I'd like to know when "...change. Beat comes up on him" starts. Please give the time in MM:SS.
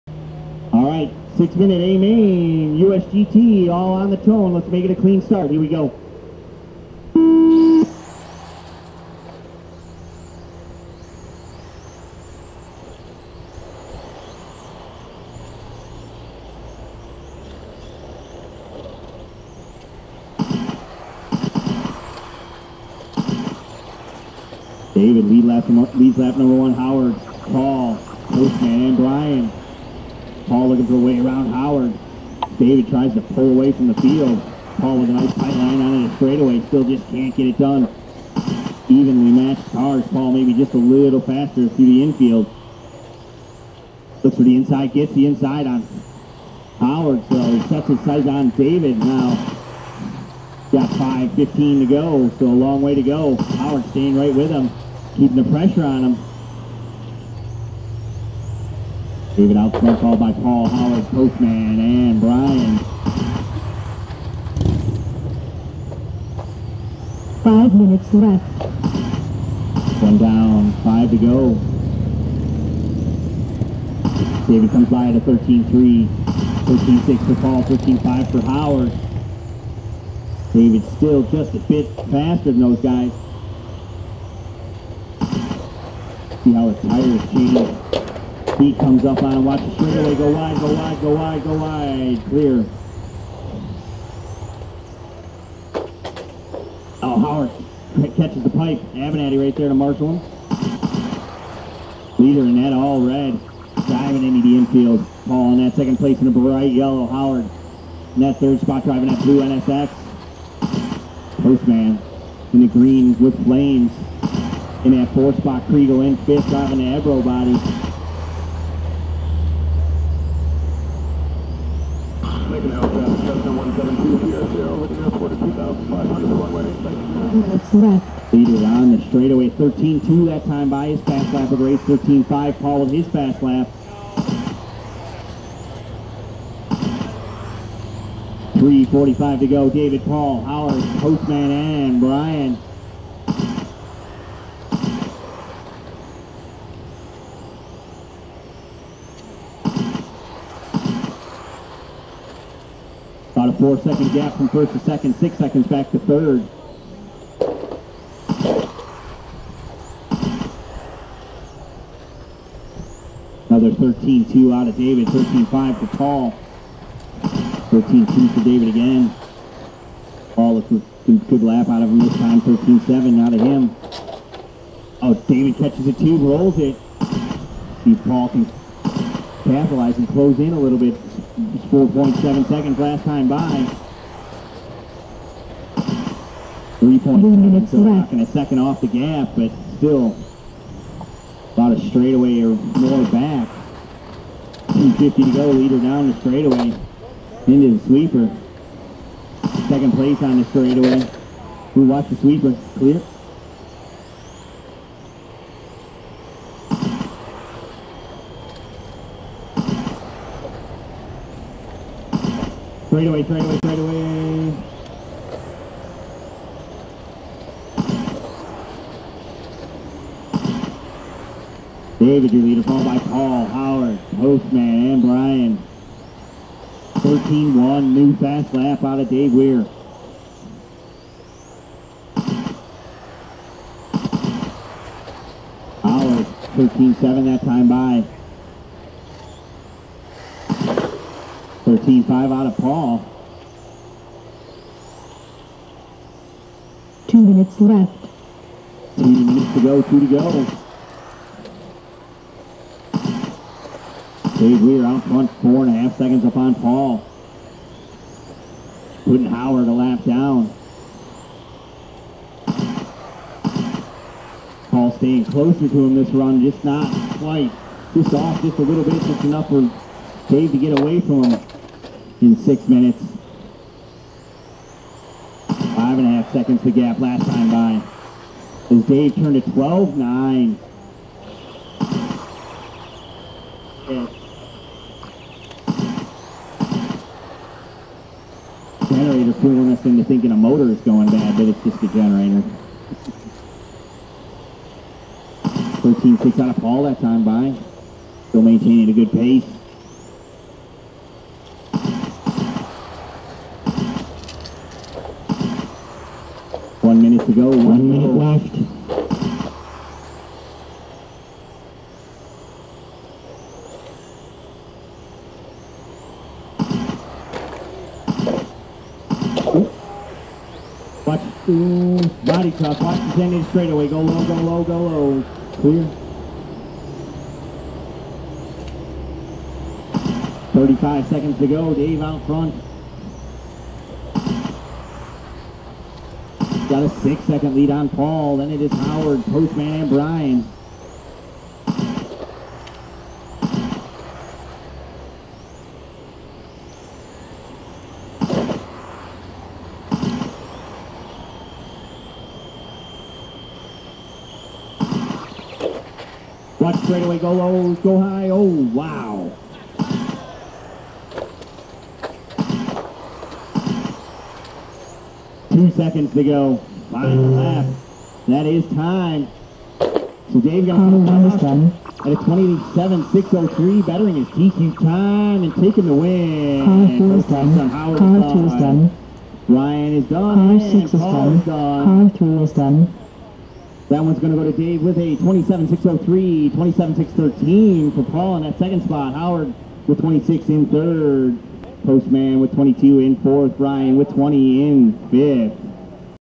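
01:27.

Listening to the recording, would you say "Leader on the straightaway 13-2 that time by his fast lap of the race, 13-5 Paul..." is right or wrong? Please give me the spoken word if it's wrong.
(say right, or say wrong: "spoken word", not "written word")
right.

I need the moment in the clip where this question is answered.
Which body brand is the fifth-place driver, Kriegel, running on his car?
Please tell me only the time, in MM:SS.
01:56.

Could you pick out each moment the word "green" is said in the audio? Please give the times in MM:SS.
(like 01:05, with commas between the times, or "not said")
01:52.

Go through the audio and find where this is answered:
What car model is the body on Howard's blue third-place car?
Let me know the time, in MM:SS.
01:49.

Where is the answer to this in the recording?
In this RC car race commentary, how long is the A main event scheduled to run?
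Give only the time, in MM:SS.
00:01.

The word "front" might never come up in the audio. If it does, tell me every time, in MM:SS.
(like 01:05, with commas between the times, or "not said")
04:15, 05:32.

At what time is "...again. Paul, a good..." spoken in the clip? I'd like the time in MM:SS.
02:48.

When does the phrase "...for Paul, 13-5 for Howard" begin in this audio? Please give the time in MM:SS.
01:17.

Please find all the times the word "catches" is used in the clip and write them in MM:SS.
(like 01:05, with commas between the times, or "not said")
01:38, 02:55.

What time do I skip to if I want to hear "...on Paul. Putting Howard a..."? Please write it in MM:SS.
04:16.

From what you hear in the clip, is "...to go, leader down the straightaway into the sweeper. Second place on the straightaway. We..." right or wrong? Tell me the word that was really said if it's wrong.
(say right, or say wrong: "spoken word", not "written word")
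right.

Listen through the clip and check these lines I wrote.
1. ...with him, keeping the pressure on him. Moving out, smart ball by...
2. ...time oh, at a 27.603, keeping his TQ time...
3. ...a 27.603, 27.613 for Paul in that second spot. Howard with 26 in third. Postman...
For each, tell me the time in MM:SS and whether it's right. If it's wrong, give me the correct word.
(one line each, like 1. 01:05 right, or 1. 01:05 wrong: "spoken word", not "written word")
1. 00:54 right
2. 06:10 wrong: "bettering", not "keeping"
3. 06:24 right.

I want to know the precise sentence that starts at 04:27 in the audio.
Just off just a little bit, just enough for Dave to get away from him in six minutes.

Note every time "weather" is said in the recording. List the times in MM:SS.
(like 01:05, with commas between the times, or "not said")
not said.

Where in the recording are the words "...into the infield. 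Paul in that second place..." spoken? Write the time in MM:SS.
01:44.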